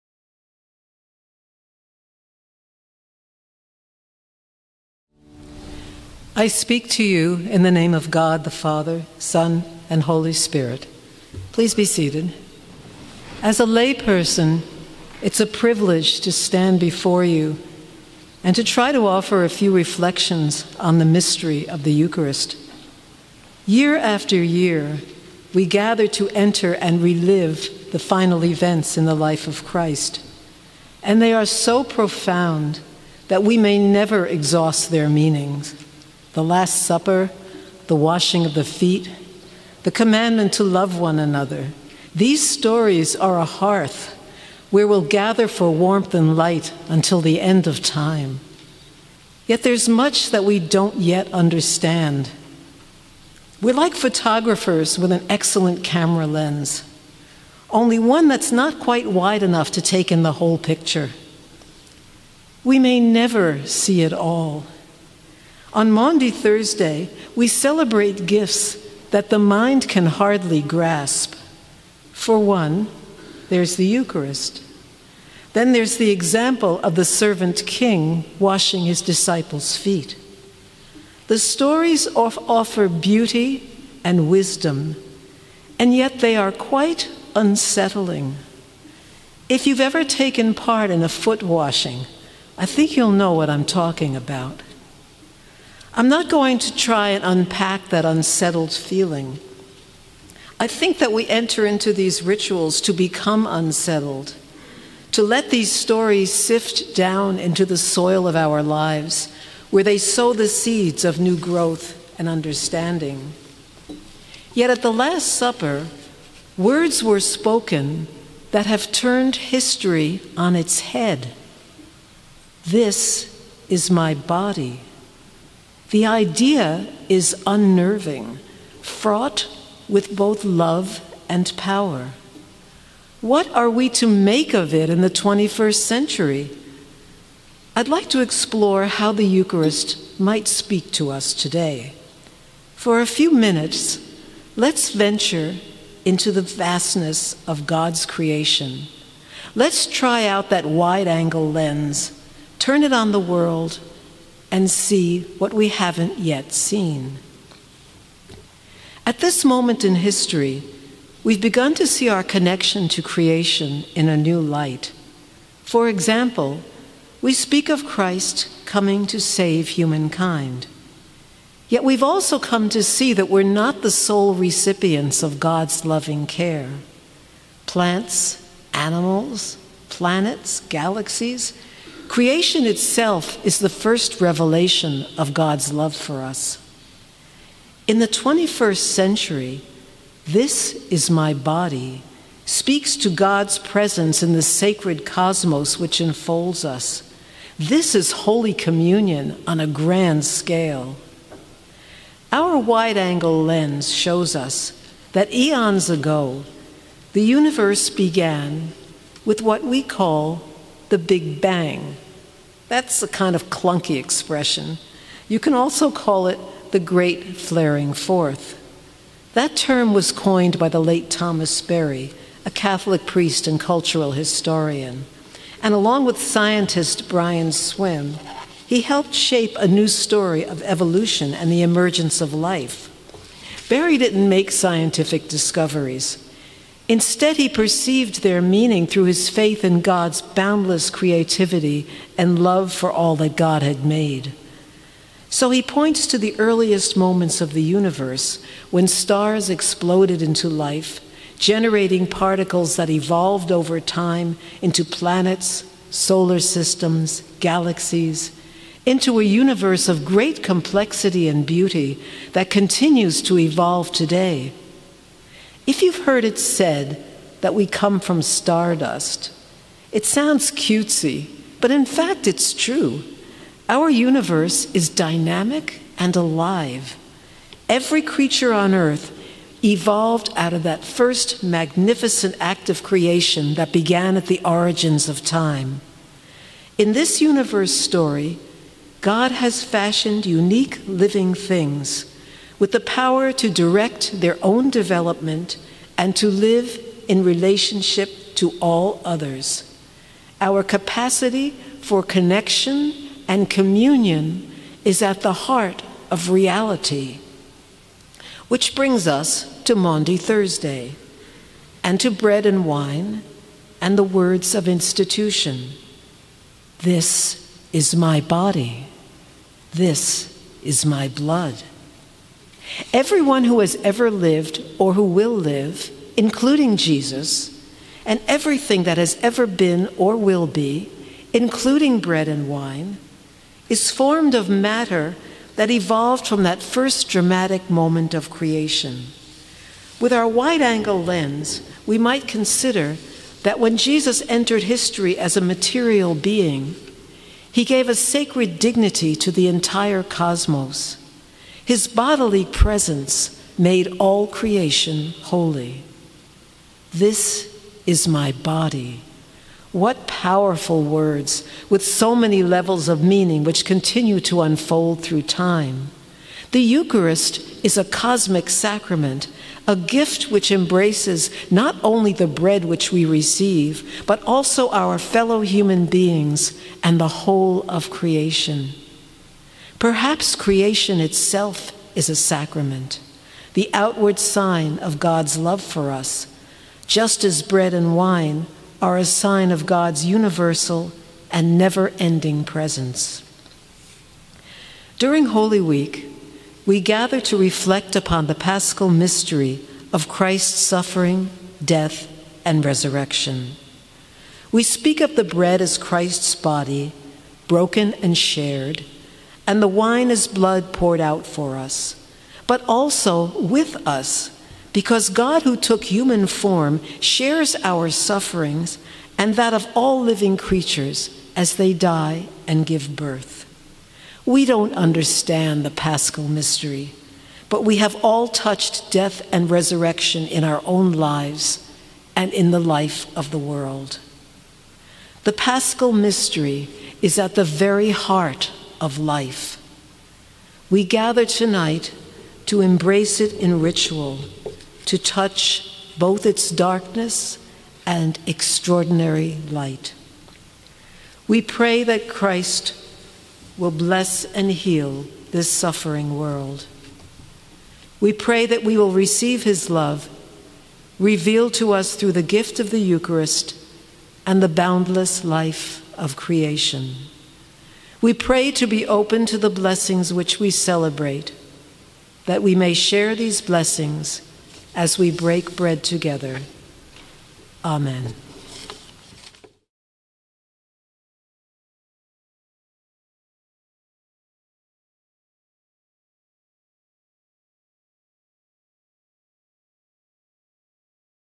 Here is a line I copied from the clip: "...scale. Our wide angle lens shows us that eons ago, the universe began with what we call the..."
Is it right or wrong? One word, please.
right.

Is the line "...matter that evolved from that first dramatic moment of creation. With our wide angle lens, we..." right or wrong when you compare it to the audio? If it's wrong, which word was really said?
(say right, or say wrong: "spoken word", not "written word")
right.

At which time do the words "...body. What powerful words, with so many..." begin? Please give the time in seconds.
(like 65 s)
358 s.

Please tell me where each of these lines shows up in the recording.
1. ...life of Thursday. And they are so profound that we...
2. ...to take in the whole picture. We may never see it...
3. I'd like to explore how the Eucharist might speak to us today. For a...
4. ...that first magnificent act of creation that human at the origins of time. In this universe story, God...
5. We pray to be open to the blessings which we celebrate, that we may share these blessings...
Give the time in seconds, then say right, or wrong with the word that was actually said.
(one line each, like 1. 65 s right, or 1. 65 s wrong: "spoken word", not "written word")
1. 29 s wrong: "Christ", not "Thursday"
2. 59 s right
3. 137 s right
4. 280 s wrong: "began", not "human"
5. 468 s right.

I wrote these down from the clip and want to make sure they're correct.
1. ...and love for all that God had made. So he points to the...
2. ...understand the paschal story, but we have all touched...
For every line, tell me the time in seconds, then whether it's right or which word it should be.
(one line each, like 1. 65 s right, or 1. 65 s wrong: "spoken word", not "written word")
1. 242 s right
2. 424 s wrong: "mystery", not "story".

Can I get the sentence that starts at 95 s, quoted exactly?
I'm not going to try and unpack that unsettled feeling.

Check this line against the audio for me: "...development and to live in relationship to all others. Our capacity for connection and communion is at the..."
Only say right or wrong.
right.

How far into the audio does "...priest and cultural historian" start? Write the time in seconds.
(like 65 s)
223 s.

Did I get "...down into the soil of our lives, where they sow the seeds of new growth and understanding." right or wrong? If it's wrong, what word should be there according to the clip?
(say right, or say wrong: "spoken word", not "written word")
right.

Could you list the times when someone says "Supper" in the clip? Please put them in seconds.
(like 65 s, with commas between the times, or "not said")
36 s, 115 s.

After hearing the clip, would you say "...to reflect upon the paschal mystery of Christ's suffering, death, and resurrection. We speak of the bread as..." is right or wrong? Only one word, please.
right.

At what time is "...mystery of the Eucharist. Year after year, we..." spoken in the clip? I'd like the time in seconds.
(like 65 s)
21 s.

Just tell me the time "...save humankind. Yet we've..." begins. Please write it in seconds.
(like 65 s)
169 s.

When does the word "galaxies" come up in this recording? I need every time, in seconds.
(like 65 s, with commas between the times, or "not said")
180 s, 257 s.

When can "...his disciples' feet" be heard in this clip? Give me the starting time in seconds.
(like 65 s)
78 s.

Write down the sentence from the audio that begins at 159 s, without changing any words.
At this moment in history, we've begun to see our connection to creation in a new light.